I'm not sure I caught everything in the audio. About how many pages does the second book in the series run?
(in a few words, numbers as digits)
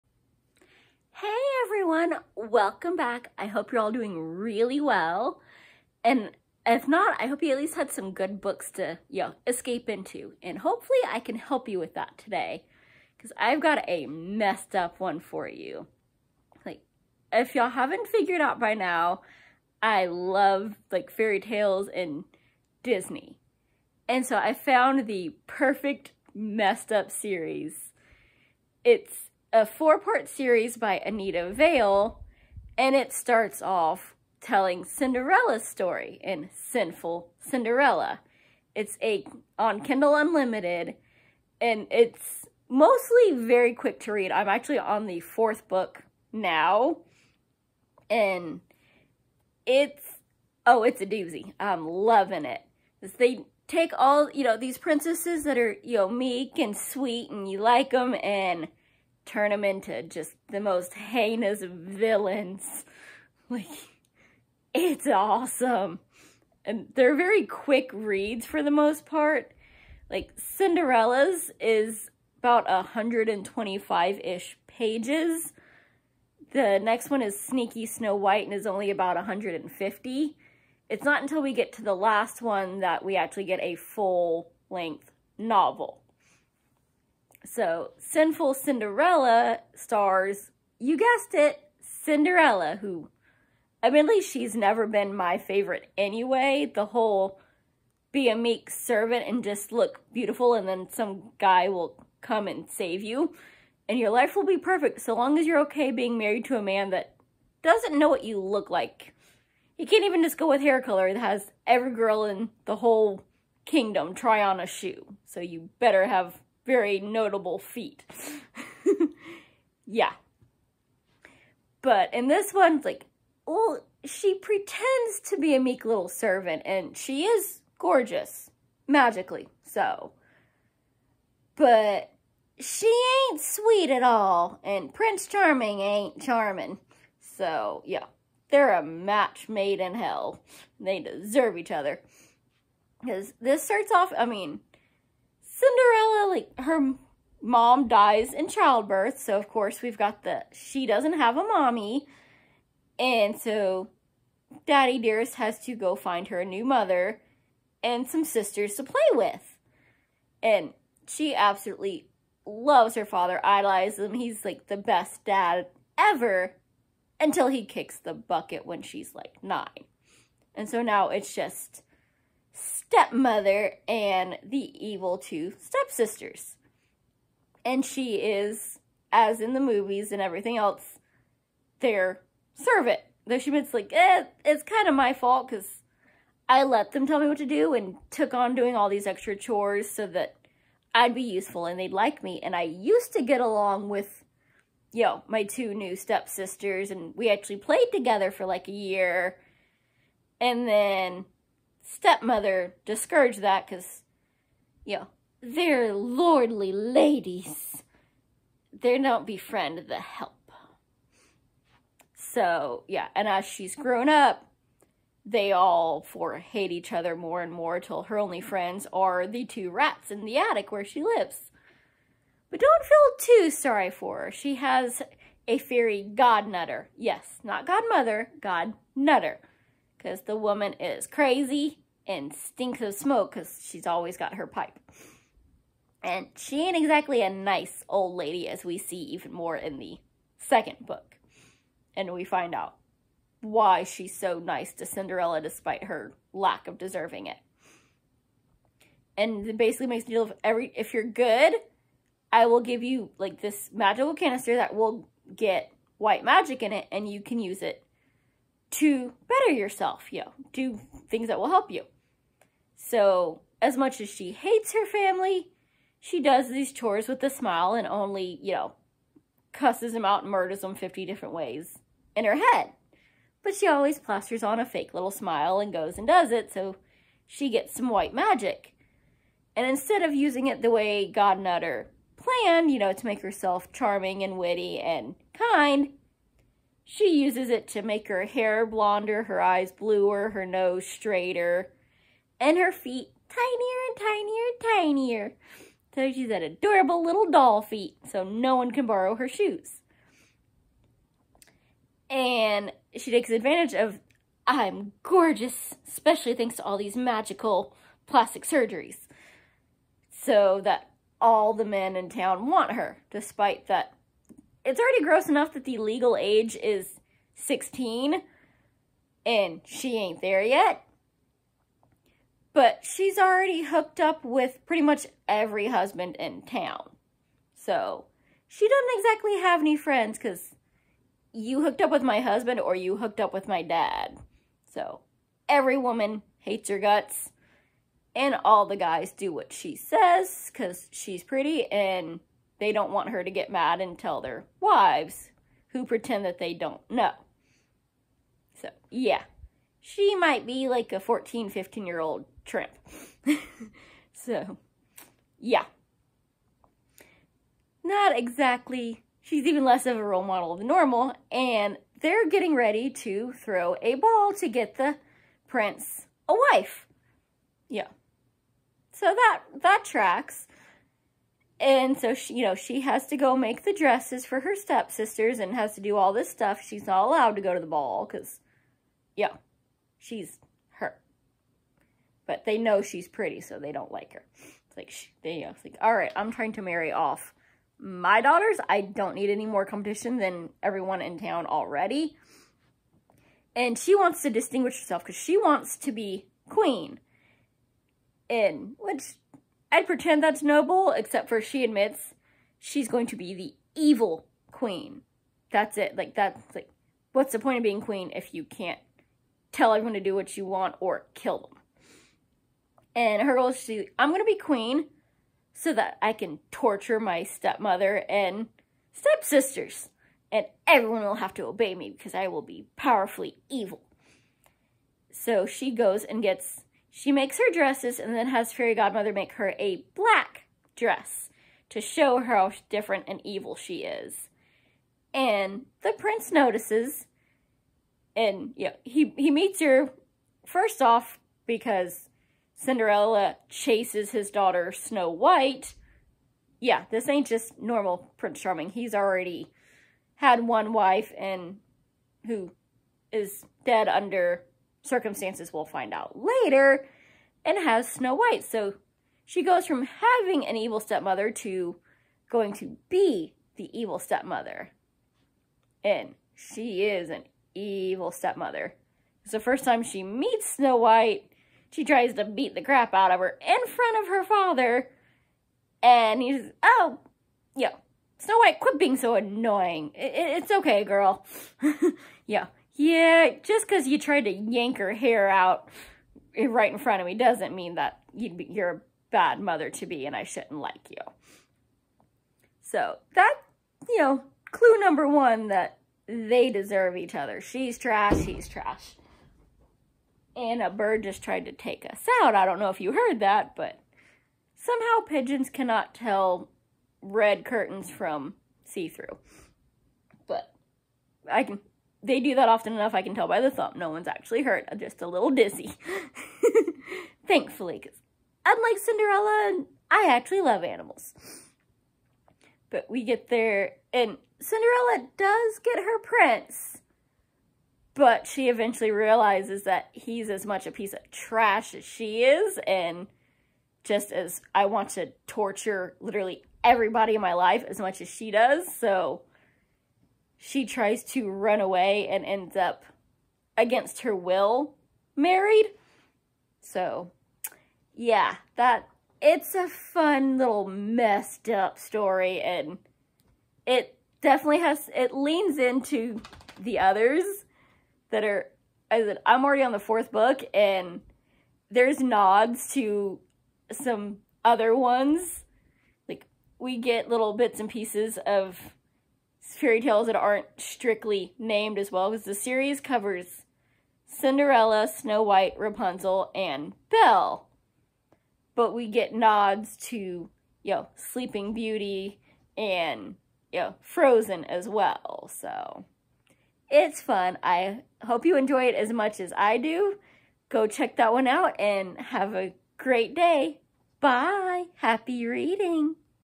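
150.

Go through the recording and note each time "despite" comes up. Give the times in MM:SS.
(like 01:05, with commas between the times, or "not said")
04:05, 05:13.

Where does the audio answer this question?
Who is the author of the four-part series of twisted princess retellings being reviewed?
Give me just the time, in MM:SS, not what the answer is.
00:31.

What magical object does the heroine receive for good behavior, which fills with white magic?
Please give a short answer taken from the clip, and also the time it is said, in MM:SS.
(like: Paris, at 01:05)
canister, at 04:13.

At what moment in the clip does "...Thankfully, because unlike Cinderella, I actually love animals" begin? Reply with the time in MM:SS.
08:37.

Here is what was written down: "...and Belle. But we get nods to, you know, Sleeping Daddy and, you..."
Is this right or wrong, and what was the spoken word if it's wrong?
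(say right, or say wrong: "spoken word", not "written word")
wrong: "Beauty", not "Daddy".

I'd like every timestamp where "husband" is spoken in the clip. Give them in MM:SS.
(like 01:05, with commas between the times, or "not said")
05:25, 05:32.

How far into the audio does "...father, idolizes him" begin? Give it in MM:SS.
02:43.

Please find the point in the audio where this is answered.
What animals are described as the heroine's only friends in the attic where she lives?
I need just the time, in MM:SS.
03:39.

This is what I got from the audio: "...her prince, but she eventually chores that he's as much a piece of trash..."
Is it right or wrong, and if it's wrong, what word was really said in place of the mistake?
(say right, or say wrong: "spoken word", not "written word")
wrong: "realizes", not "chores".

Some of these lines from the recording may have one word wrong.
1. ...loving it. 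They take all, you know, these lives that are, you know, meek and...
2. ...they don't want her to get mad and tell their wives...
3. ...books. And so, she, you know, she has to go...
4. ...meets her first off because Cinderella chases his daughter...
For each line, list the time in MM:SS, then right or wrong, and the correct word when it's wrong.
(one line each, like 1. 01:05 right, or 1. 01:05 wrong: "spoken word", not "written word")
1. 00:51 wrong: "princesses", not "lives"
2. 05:42 right
3. 06:09 wrong: "tracks", not "books"
4. 07:19 right.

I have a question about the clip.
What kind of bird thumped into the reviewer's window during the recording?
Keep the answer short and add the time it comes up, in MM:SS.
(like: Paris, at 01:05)
pigeons, at 08:25.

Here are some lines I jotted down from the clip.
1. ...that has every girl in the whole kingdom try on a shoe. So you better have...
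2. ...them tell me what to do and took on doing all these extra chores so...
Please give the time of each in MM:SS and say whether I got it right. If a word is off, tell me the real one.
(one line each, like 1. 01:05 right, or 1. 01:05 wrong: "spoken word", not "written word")
1. 01:51 right
2. 03:06 right.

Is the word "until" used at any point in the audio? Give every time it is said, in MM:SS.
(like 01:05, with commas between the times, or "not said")
01:21, 02:47.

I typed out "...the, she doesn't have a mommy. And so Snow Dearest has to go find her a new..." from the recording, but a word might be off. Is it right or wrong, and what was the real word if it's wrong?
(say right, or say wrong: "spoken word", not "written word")
wrong: "Daddy", not "Snow".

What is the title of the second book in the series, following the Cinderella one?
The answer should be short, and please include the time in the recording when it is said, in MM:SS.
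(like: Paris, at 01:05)
Sneaky Snow White, at 01:17.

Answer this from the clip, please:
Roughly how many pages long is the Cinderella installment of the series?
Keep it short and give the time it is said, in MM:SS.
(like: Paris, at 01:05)
125, at 01:12.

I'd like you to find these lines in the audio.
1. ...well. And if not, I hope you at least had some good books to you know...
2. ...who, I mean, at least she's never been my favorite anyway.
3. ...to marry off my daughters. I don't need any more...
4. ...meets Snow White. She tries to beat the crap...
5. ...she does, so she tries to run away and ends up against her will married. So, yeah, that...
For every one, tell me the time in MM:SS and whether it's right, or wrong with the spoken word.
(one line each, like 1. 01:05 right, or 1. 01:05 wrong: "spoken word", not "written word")
1. 00:04 right
2. 01:32 right
3. 06:26 right
4. 07:50 right
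5. 08:58 right.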